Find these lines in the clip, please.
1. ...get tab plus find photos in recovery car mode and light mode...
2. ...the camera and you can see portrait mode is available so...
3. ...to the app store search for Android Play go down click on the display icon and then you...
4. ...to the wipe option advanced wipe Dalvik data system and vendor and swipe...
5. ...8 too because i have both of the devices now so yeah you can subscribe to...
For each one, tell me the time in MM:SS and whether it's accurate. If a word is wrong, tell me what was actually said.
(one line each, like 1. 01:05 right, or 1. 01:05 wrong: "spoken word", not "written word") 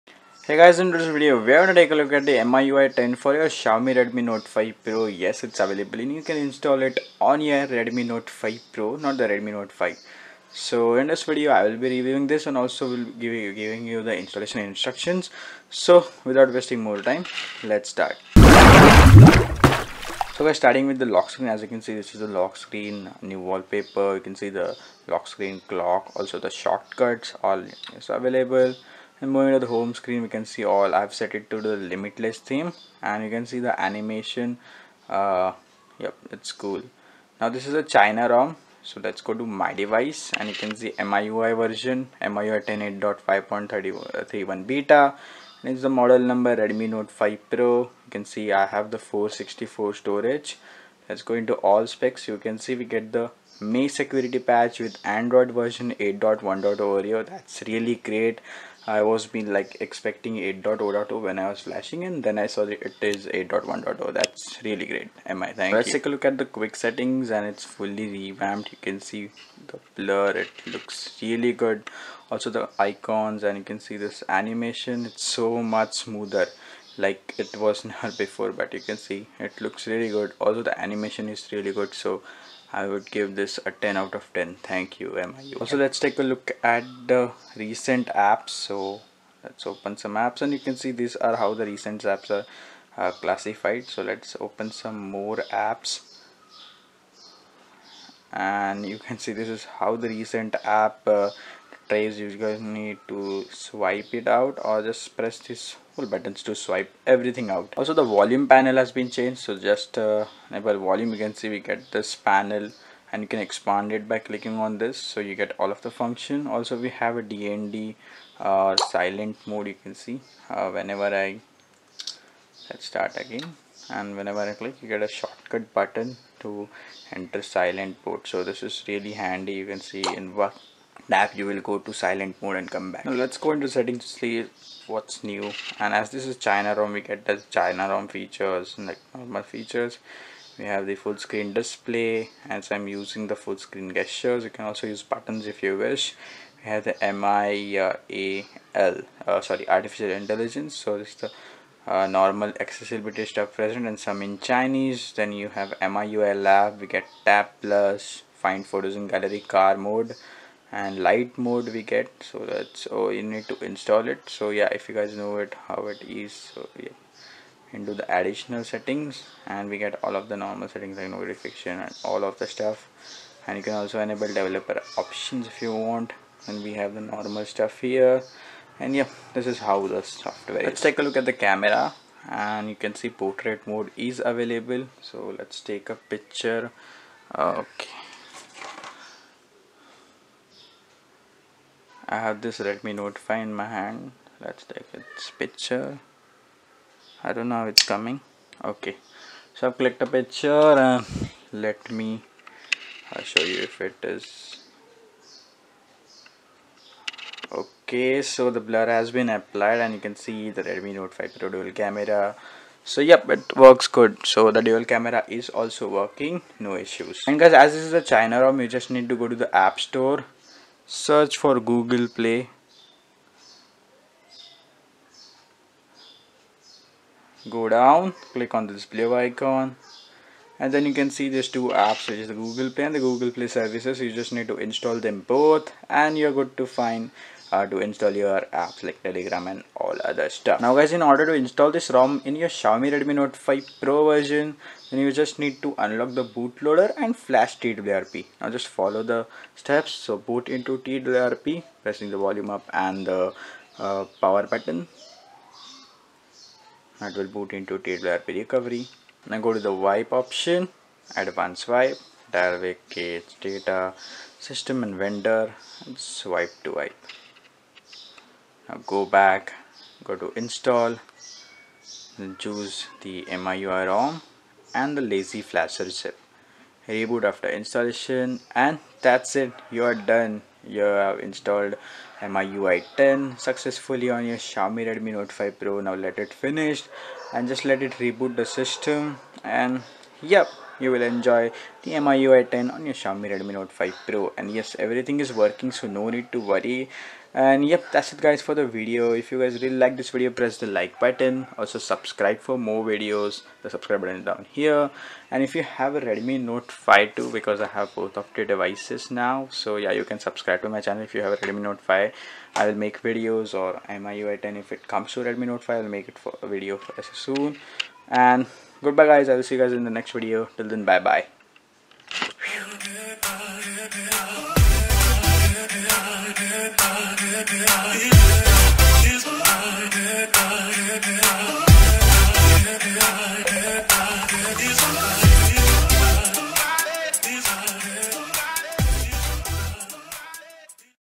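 1. 02:36 wrong: "gallery", not "recovery"
2. 03:01 right
3. 03:39 wrong: "Google", not "Android"
4. 04:19 right
5. 05:06 wrong: "5", not "8".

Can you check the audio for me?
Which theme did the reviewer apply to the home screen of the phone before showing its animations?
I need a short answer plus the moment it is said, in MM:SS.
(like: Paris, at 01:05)
Limitless, at 00:31.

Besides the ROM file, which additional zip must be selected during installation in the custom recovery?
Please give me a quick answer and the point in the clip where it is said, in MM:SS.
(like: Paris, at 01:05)
Lazy flasher, at 04:35.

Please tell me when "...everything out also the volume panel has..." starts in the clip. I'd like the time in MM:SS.
01:47.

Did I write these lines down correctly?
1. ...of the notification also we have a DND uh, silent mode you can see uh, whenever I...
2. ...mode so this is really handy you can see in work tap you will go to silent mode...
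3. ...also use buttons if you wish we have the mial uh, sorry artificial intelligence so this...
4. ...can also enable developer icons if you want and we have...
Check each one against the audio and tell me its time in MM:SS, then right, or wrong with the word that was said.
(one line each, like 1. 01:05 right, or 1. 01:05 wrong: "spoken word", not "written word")
1. 01:55 wrong: "function", not "notification"
2. 02:08 right
3. 02:24 right
4. 02:53 wrong: "options", not "icons".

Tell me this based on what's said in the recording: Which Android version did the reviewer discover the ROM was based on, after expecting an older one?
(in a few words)
8.1.0.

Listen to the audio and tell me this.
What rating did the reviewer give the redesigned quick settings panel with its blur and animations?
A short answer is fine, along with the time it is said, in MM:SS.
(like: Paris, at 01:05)
10 out of 10, at 01:23.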